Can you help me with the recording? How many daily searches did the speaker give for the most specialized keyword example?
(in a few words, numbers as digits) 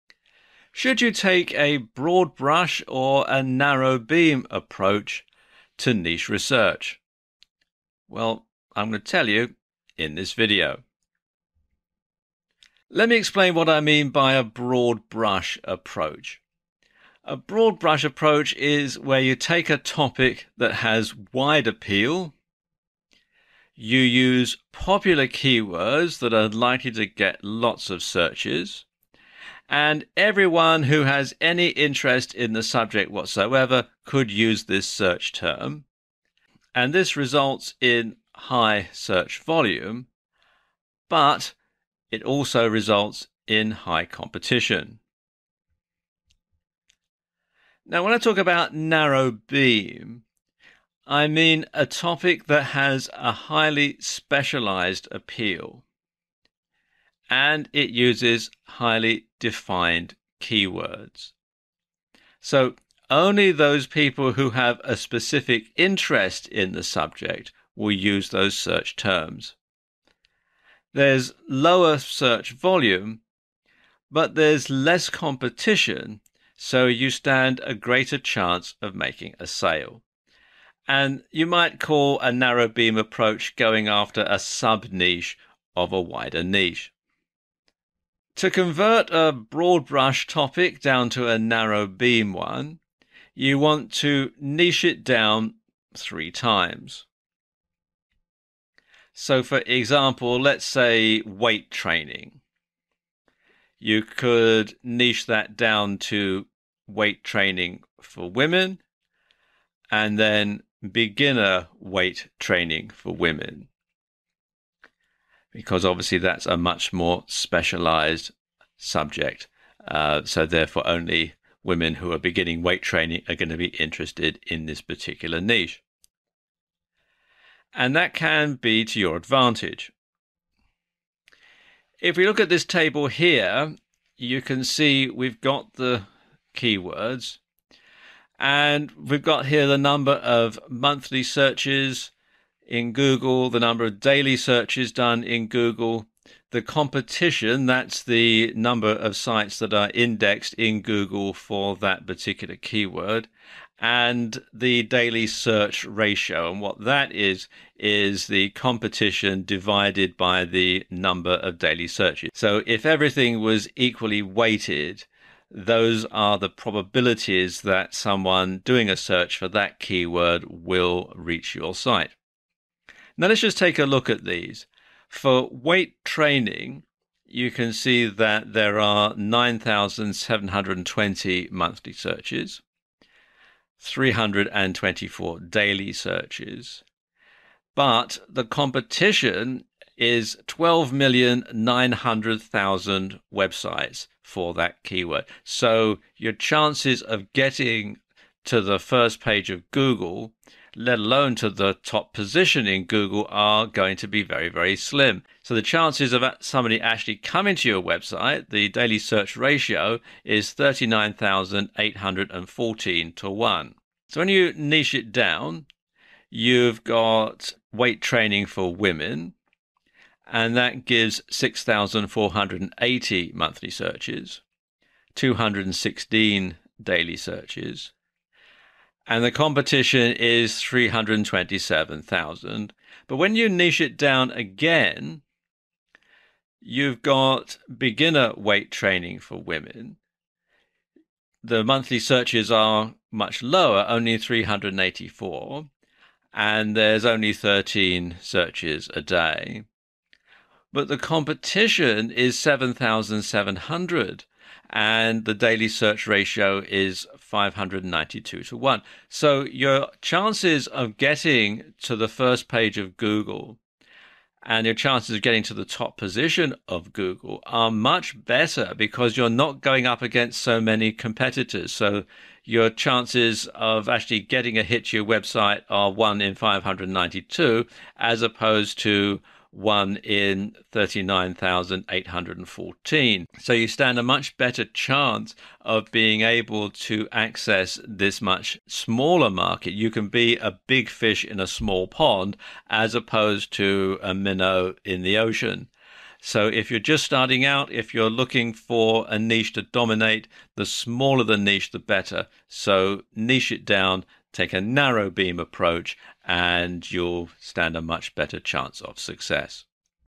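13.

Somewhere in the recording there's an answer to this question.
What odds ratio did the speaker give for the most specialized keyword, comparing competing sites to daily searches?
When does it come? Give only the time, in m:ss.
4:17.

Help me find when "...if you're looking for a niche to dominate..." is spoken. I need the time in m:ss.
4:57.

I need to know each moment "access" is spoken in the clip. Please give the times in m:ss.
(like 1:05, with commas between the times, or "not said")
4:47.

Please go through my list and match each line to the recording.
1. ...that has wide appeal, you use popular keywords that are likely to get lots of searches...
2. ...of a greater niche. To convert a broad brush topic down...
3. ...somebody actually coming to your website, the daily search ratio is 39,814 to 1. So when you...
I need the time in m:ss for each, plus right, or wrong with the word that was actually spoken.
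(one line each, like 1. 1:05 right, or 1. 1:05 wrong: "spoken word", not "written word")
1. 0:20 right
2. 1:25 wrong: "wider", not "greater"
3. 3:26 right.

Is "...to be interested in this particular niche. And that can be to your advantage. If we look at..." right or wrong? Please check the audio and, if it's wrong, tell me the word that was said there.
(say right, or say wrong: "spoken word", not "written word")
right.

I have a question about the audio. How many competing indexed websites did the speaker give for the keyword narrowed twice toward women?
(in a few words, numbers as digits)
327,000.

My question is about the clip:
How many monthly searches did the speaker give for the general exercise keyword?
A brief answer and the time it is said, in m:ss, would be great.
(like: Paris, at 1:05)
9,720, at 2:59.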